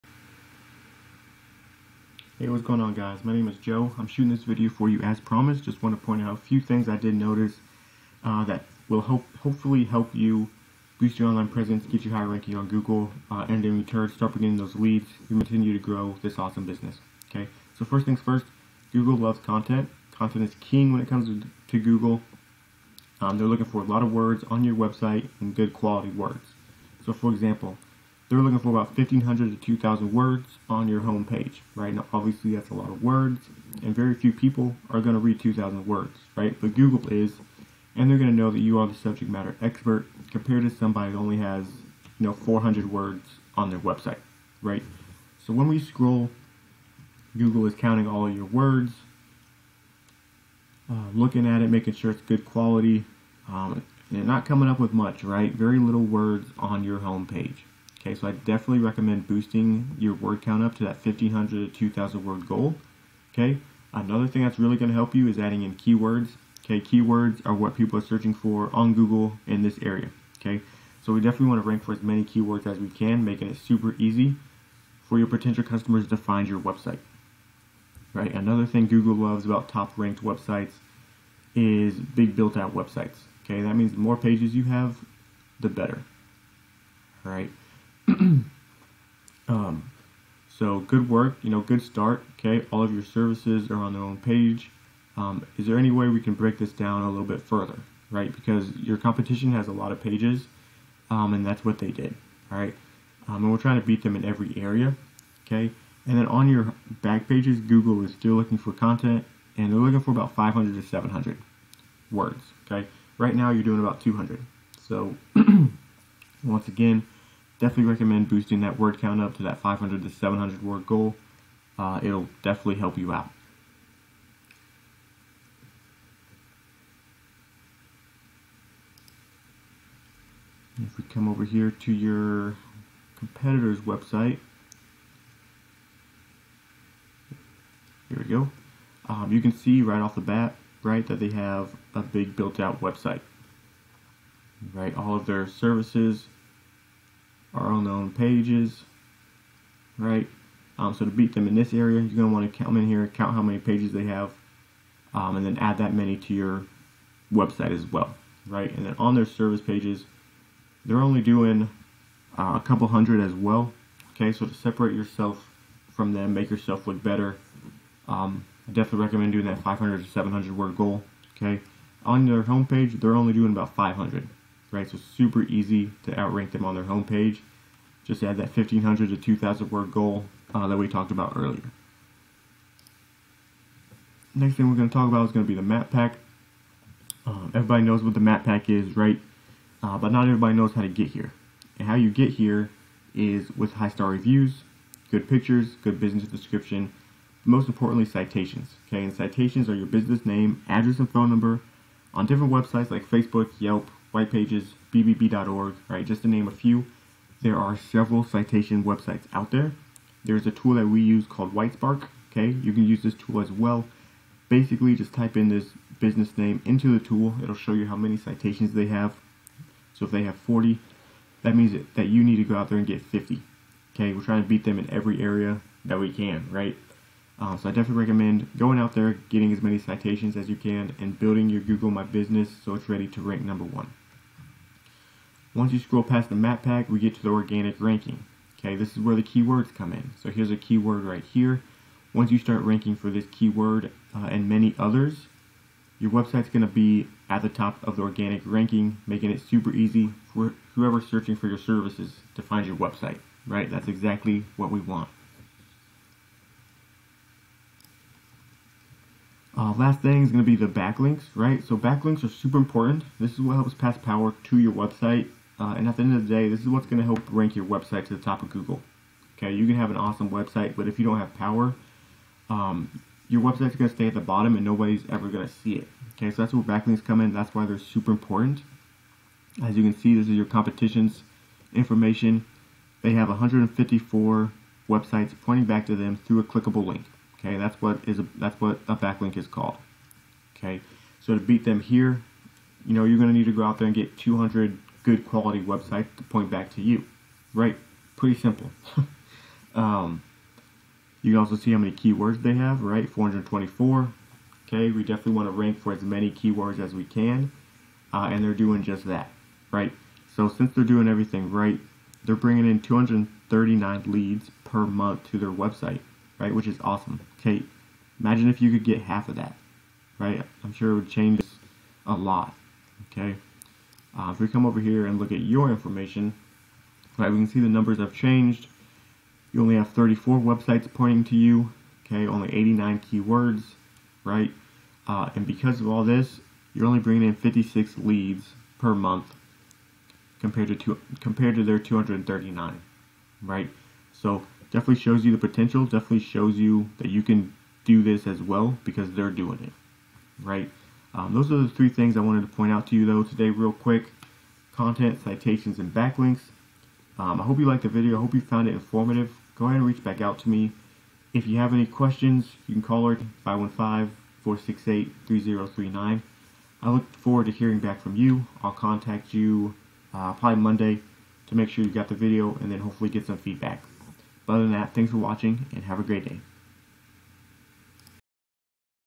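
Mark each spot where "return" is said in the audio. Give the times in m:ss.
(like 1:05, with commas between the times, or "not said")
0:13.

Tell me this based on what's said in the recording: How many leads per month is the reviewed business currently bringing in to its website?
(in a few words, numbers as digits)
56.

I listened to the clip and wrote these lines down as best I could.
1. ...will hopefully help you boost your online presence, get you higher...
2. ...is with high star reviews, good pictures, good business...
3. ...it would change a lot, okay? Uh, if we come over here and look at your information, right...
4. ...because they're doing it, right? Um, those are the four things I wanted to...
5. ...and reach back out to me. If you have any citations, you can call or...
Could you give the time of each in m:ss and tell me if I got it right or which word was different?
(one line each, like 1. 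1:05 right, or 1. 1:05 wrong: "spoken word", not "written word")
1. 0:08 right
2. 3:13 right
3. 5:20 right
4. 5:48 wrong: "three", not "four"
5. 5:59 wrong: "questions", not "citations".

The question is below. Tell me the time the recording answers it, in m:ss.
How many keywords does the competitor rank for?
5:03.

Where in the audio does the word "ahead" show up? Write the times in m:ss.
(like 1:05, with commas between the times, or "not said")
5:59.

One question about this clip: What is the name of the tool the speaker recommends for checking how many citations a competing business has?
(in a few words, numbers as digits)
Whitespark.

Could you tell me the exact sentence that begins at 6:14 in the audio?
But other than that, thanks for watching and have a great day.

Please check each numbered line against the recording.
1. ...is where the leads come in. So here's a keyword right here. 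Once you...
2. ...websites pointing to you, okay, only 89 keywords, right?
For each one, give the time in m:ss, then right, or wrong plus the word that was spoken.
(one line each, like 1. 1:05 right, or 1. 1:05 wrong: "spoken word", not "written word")
1. 3:58 wrong: "keywords", not "leads"
2. 5:30 right.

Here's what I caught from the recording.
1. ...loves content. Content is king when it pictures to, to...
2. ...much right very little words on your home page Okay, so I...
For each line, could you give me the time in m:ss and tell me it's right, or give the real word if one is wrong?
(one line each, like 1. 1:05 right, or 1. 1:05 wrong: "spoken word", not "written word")
1. 0:19 wrong: "comes", not "pictures"
2. 0:54 right.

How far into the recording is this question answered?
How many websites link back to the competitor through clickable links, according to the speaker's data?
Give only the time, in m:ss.
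4:43.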